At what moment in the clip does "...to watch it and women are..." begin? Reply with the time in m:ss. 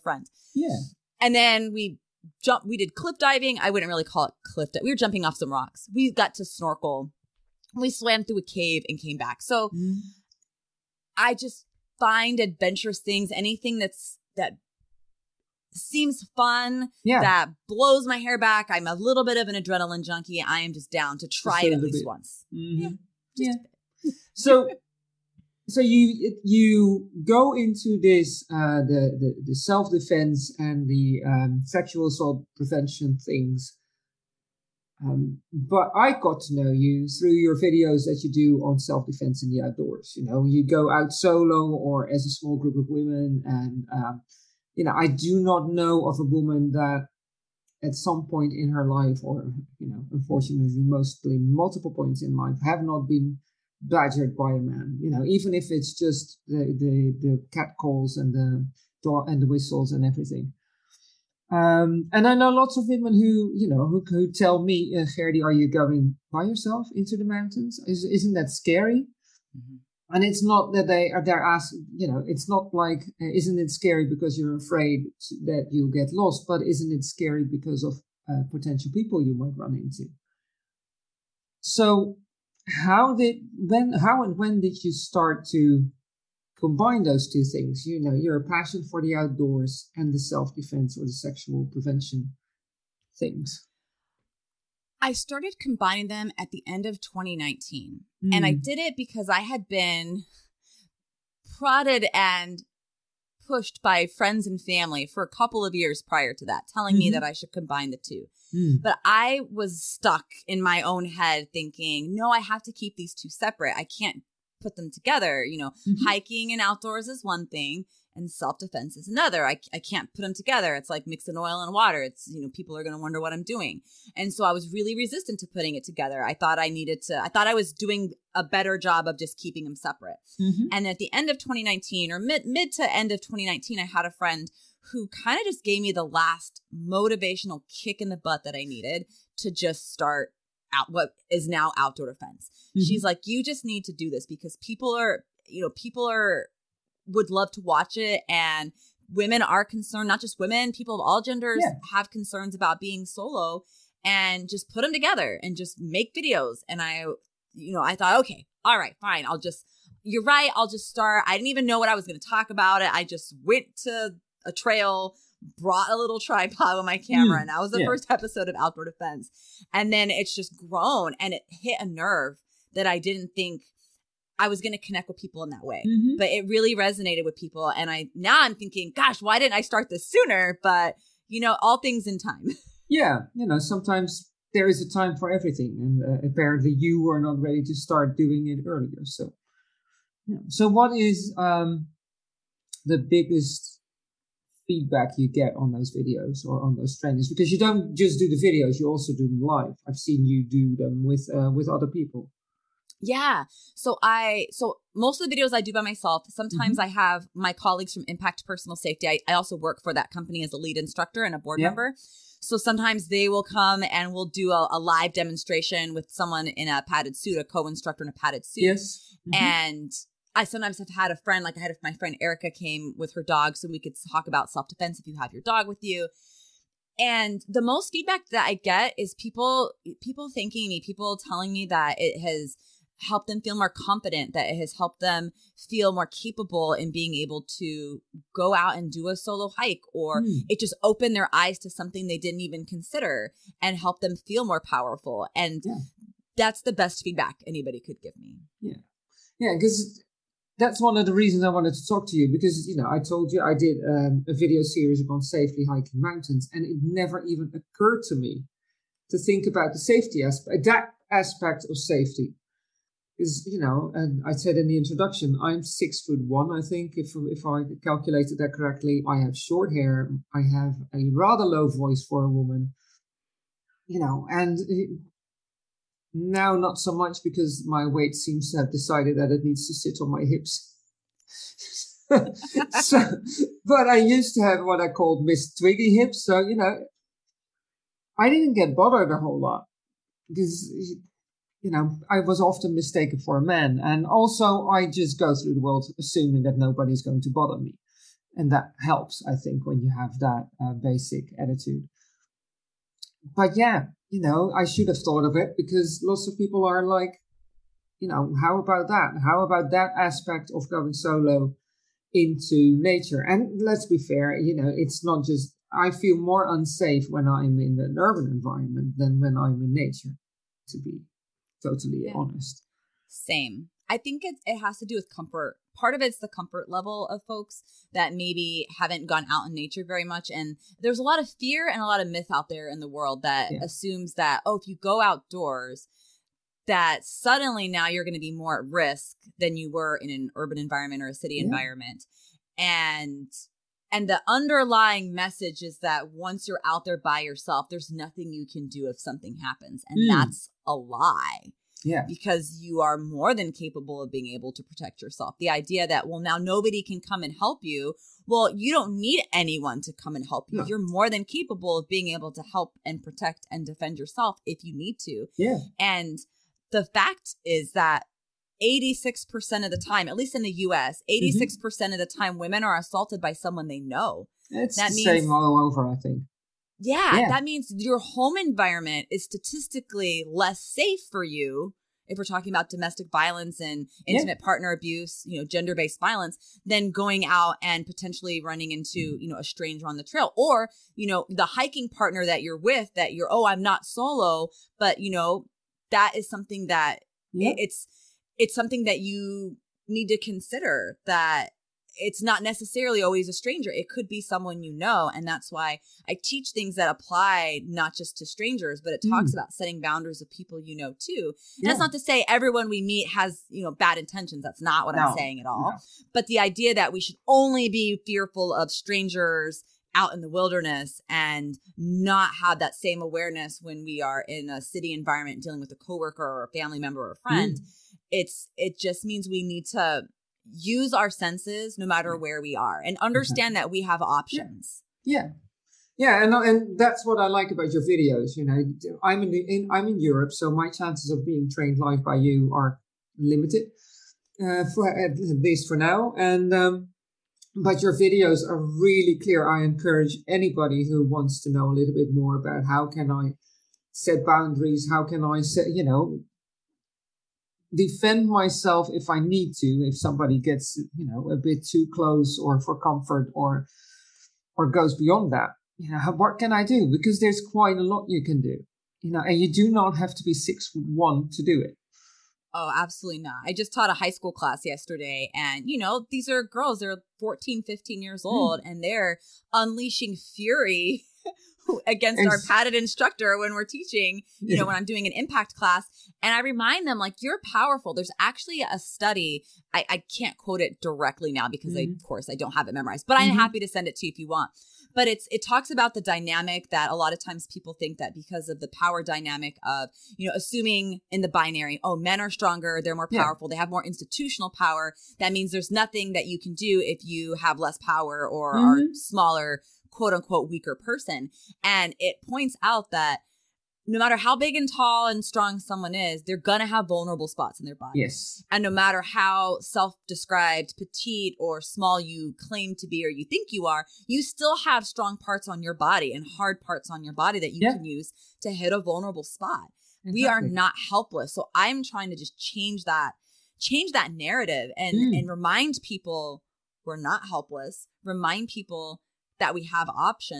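2:27.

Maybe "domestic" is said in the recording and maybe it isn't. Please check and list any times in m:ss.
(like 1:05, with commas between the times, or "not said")
6:22.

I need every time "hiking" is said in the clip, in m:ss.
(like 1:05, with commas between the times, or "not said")
1:56, 4:15, 6:31.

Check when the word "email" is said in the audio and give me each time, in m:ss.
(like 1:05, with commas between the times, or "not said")
not said.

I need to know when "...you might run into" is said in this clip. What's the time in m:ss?
1:19.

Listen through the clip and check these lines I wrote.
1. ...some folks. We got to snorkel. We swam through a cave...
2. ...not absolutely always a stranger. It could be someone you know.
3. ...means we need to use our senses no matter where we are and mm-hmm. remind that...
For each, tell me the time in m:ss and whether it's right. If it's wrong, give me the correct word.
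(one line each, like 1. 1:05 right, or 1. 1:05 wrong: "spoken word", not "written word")
1. 0:05 wrong: "rocks", not "folks"
2. 6:42 wrong: "necessarily", not "absolutely"
3. 7:09 wrong: "understand", not "remind".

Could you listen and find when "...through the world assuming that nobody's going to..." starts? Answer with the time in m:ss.
4:55.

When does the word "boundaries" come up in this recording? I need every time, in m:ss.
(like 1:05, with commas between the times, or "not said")
6:49, 7:34.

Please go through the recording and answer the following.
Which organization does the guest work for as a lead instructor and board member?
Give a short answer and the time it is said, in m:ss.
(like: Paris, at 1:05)
Impact Personal Safety, at 3:28.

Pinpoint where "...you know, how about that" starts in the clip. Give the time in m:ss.
5:07.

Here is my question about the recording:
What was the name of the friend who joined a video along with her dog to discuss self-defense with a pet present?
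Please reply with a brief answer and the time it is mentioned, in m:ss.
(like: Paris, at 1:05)
Erica, at 3:42.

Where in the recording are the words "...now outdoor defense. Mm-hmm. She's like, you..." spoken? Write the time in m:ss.
2:21.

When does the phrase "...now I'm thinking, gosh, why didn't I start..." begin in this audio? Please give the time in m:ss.
2:58.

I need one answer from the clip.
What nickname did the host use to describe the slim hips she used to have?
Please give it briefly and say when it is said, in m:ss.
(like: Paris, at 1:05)
Miss Twiggy hips, at 4:45.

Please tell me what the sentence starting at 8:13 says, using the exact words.
I'm happy to send it to you if you want.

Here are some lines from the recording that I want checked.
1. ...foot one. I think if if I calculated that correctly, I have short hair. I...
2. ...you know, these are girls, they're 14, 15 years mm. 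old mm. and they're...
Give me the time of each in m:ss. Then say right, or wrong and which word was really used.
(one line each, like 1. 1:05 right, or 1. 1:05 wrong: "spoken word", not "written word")
1. 4:26 right
2. 7:55 right.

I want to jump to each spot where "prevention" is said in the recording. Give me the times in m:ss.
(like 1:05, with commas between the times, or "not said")
0:32, 1:31.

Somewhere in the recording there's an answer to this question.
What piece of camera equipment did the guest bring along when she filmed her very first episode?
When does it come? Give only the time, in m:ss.
2:45.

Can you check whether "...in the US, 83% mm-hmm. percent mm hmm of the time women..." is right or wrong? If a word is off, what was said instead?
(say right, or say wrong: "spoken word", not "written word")
wrong: "86", not "83".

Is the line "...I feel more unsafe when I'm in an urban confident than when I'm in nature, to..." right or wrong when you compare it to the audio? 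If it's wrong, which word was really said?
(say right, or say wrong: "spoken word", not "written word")
wrong: "environment", not "confident".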